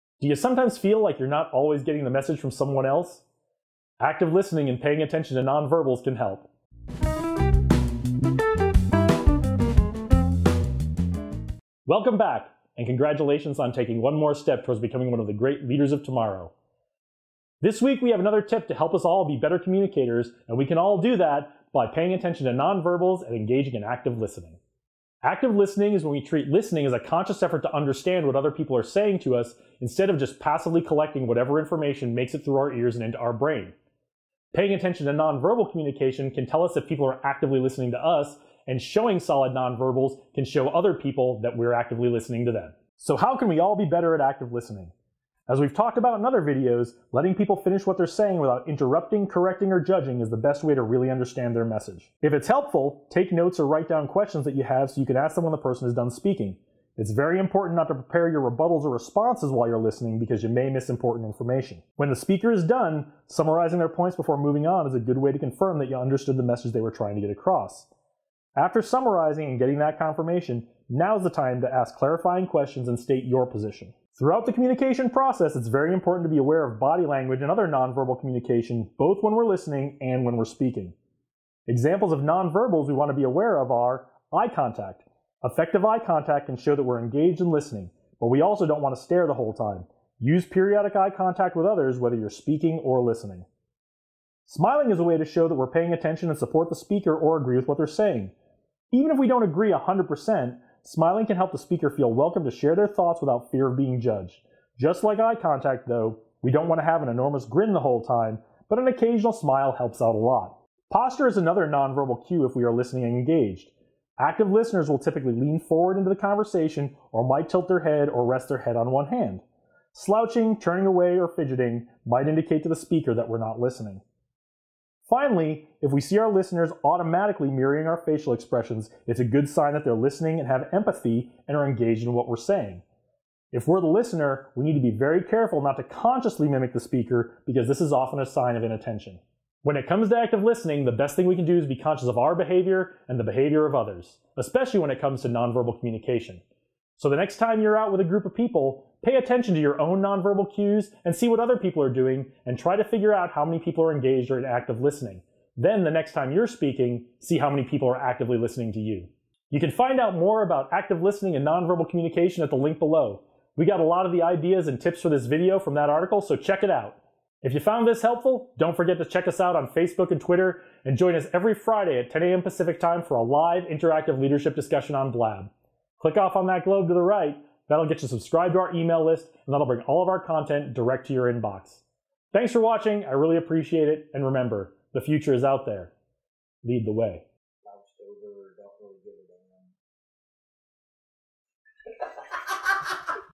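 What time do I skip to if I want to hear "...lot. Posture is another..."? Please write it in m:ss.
1:50.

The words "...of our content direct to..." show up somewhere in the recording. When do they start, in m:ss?
3:00.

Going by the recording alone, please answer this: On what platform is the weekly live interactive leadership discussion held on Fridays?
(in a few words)
Blab.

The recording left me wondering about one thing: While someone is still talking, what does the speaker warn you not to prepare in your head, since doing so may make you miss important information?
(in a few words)
rebuttals.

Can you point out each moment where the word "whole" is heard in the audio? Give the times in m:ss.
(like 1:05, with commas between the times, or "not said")
1:29, 1:47.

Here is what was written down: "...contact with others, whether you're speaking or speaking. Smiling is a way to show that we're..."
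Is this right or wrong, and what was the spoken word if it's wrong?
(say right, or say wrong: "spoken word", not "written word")
wrong: "listening", not "speaking".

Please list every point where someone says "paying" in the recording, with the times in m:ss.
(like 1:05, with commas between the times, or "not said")
0:04, 0:21, 0:34, 1:35.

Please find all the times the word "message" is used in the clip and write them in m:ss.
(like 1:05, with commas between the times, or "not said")
0:02, 0:51, 1:06.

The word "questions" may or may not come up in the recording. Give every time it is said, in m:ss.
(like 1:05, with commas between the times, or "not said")
0:54, 1:12.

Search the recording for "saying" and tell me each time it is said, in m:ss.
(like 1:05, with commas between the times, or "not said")
0:28, 0:48, 1:37, 2:12.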